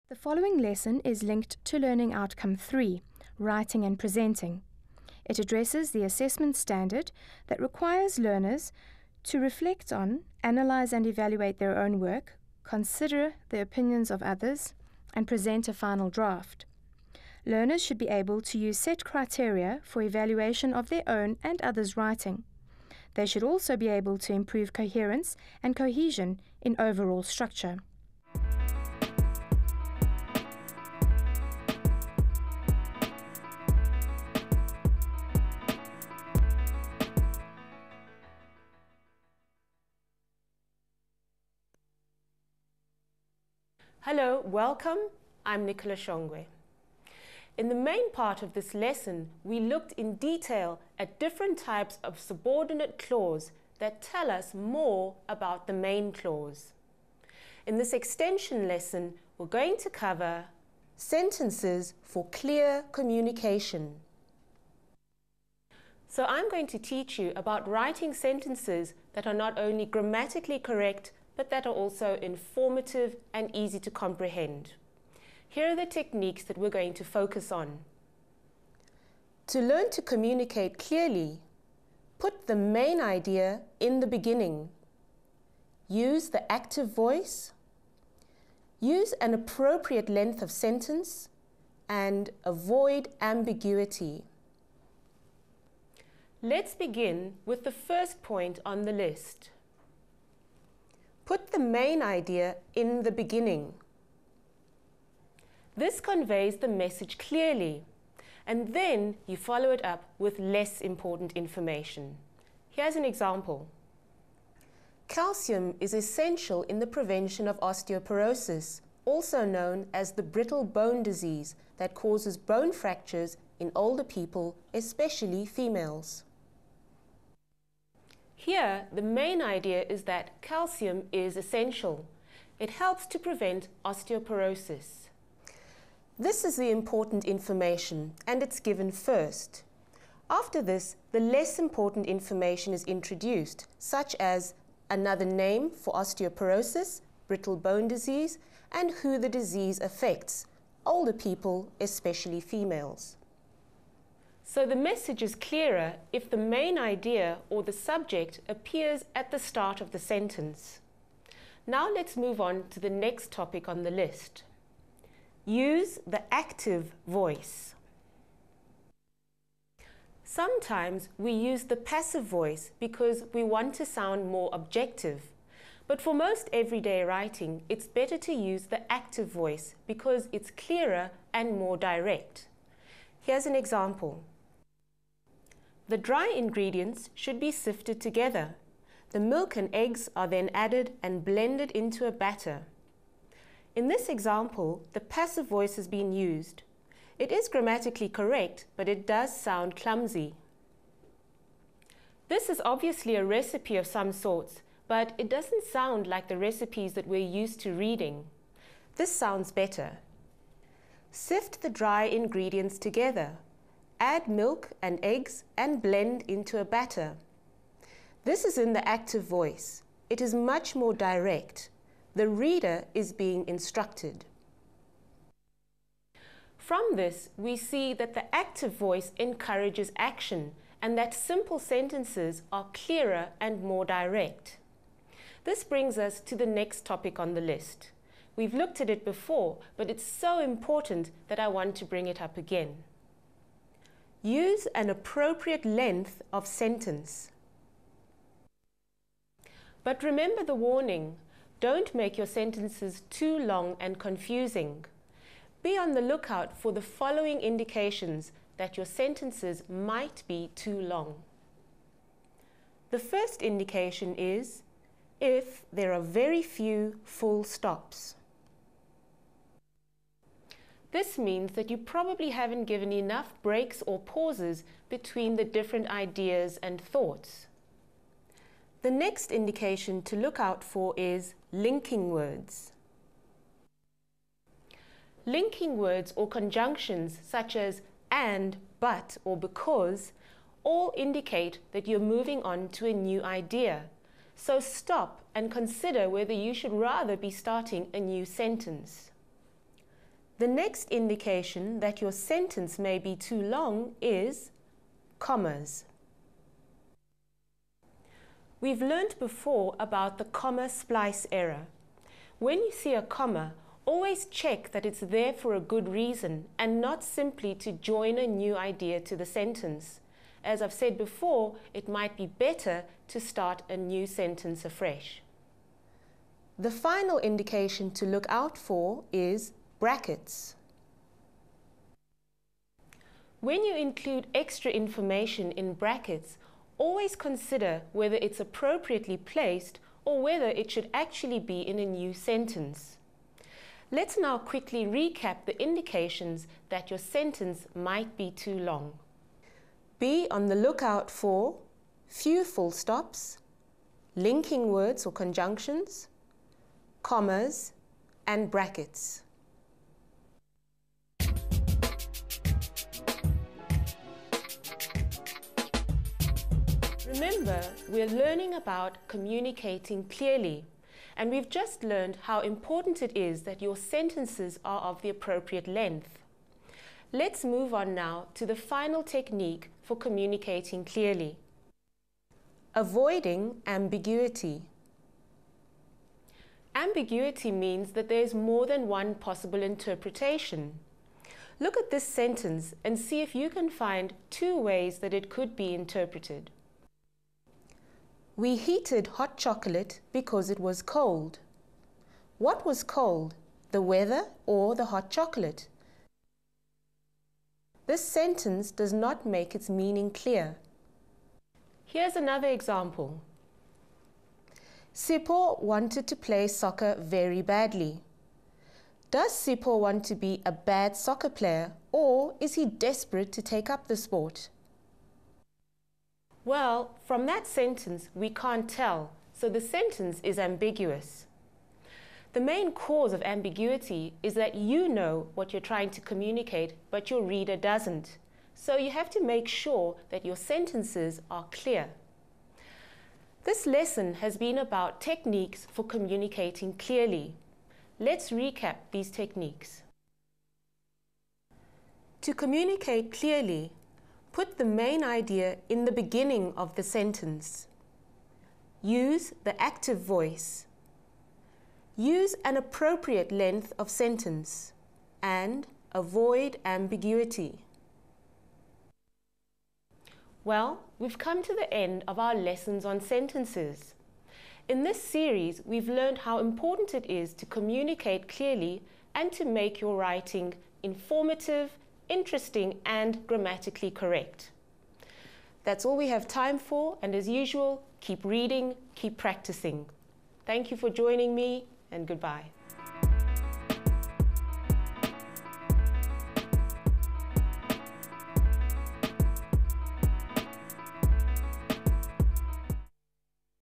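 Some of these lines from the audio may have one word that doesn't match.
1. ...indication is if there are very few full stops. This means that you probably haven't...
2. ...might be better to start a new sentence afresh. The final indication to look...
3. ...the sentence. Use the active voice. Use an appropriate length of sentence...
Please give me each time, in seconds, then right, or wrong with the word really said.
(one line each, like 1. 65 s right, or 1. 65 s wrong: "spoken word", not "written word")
1. 263 s right
2. 321 s right
3. 456 s right.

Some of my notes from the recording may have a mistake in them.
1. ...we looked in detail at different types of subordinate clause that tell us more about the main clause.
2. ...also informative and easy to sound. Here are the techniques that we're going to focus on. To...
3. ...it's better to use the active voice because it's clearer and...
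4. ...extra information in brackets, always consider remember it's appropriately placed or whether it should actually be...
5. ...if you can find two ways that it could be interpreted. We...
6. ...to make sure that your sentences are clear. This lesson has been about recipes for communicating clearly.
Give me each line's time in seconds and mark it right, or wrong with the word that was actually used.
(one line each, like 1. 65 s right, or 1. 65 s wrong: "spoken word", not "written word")
1. 49 s right
2. 71 s wrong: "comprehend", not "sound"
3. 177 s right
4. 334 s wrong: "whether", not "remember"
5. 393 s right
6. 439 s wrong: "techniques", not "recipes".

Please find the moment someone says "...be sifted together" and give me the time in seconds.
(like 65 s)
187 s.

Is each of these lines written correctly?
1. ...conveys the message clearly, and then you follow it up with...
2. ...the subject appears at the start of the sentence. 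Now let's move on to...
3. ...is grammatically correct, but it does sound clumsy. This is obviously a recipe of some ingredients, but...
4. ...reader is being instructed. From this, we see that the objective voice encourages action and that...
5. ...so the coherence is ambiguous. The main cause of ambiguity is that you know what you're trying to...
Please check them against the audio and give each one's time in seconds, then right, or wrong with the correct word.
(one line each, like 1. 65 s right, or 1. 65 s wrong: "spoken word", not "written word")
1. 106 s right
2. 157 s right
3. 197 s wrong: "sorts", not "ingredients"
4. 222 s wrong: "active", not "objective"
5. 429 s wrong: "sentence", not "coherence".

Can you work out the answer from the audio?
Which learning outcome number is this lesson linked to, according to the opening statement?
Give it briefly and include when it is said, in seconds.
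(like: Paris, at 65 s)
3, at 1 s.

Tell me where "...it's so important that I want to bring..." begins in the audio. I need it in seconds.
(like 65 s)
239 s.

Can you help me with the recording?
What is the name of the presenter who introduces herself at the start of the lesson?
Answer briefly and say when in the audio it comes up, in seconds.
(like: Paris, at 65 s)
Nicola Shongwe, at 45 s.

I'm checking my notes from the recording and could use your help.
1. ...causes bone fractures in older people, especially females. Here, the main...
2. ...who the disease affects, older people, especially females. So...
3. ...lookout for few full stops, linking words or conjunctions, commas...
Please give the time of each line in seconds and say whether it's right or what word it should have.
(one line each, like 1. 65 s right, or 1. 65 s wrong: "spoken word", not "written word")
1. 121 s right
2. 148 s right
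3. 350 s right.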